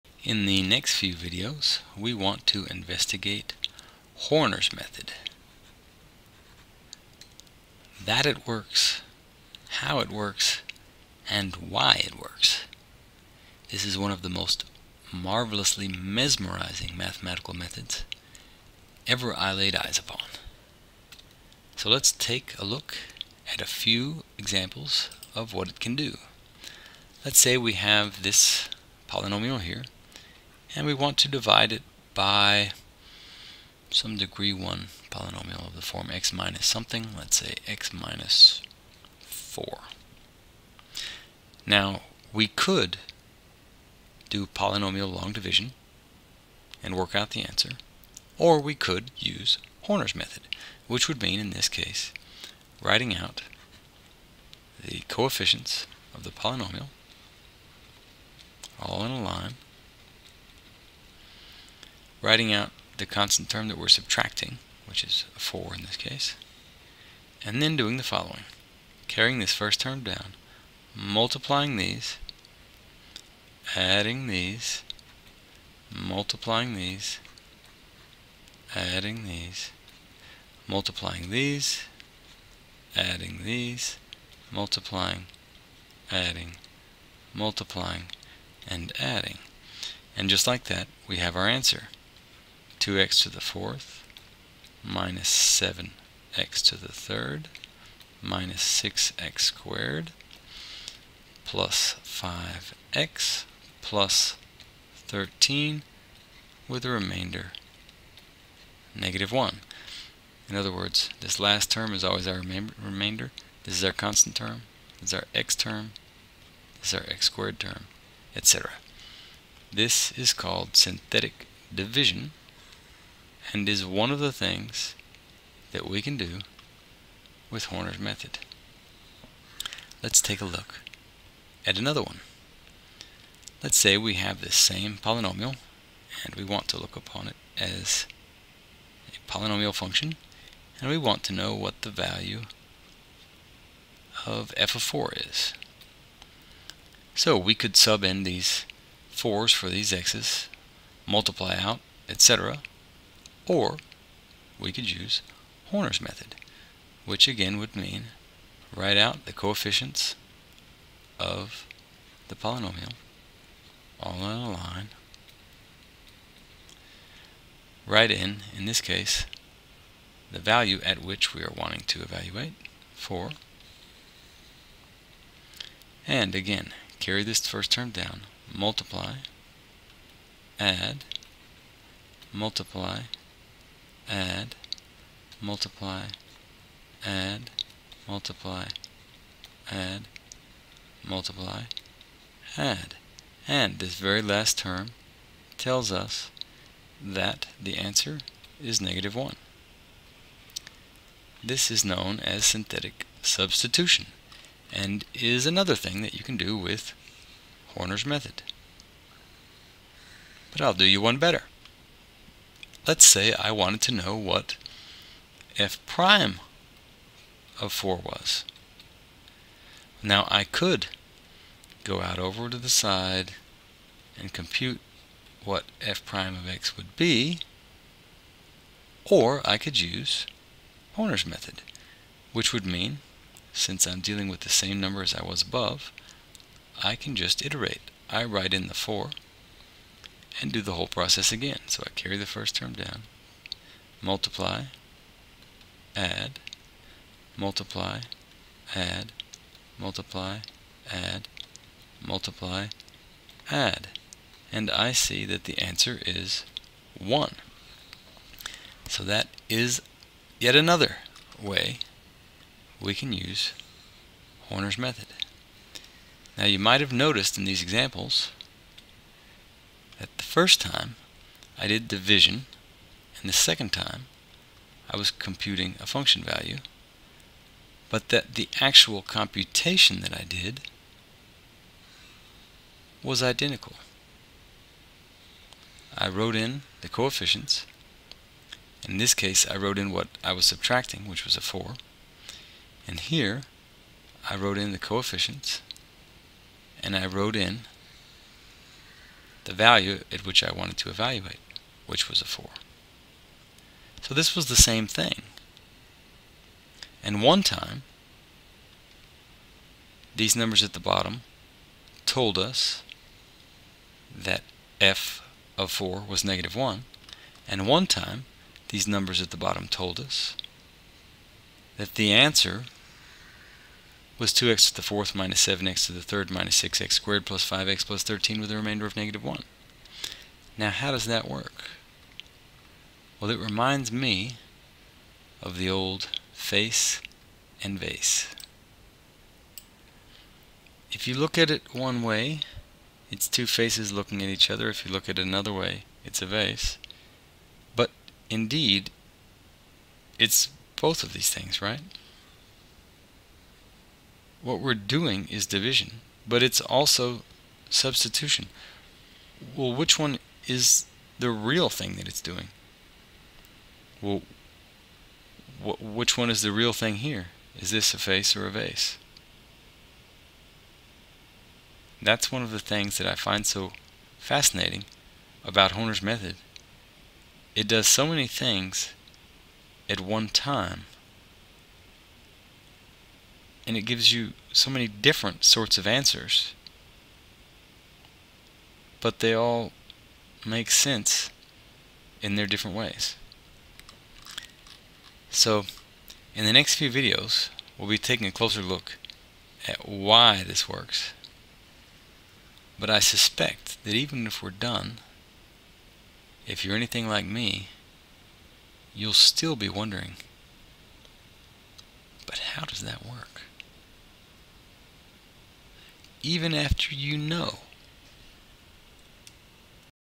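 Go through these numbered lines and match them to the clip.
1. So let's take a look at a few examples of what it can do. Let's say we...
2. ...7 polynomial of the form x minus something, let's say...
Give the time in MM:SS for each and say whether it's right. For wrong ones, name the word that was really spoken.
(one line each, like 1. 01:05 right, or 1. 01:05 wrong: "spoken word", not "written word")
1. 00:21 right
2. 00:34 wrong: "1", not "7".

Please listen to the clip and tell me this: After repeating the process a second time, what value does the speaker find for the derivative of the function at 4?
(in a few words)
1.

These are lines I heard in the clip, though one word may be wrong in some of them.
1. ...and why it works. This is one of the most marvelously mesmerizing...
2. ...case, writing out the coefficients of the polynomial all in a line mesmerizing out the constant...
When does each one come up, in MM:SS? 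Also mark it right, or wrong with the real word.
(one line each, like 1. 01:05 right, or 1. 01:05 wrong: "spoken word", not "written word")
1. 00:11 right
2. 00:51 wrong: "writing", not "mesmerizing".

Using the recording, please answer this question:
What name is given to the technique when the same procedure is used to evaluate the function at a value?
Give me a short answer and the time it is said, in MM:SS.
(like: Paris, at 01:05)
synthetic substitution, at 03:22.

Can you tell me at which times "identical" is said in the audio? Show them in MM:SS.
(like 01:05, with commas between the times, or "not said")
04:43.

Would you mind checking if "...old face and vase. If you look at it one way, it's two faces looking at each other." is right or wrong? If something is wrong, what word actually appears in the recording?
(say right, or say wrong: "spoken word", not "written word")
right.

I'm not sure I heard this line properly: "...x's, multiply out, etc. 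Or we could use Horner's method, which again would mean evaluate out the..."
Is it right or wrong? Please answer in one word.
wrong.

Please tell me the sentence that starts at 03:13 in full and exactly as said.
And this very last term tells us that the answer is negative 1.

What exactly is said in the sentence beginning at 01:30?
And just like that, we have our answer.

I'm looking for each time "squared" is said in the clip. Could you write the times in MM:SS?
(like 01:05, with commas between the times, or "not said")
01:39, 01:57, 05:26.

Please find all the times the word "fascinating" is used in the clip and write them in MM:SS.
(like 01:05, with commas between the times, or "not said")
06:14.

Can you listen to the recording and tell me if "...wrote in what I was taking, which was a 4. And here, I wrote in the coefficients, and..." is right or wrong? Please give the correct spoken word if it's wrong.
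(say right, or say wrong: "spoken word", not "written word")
wrong: "subtracting", not "taking".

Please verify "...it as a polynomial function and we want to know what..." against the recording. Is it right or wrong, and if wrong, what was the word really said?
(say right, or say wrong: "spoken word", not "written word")
right.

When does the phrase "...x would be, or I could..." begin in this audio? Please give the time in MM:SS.
03:46.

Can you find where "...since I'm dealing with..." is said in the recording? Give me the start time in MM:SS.
03:53.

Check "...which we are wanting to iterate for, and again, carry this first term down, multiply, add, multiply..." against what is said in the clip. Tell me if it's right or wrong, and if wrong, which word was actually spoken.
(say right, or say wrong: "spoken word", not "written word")
wrong: "evaluate", not "iterate".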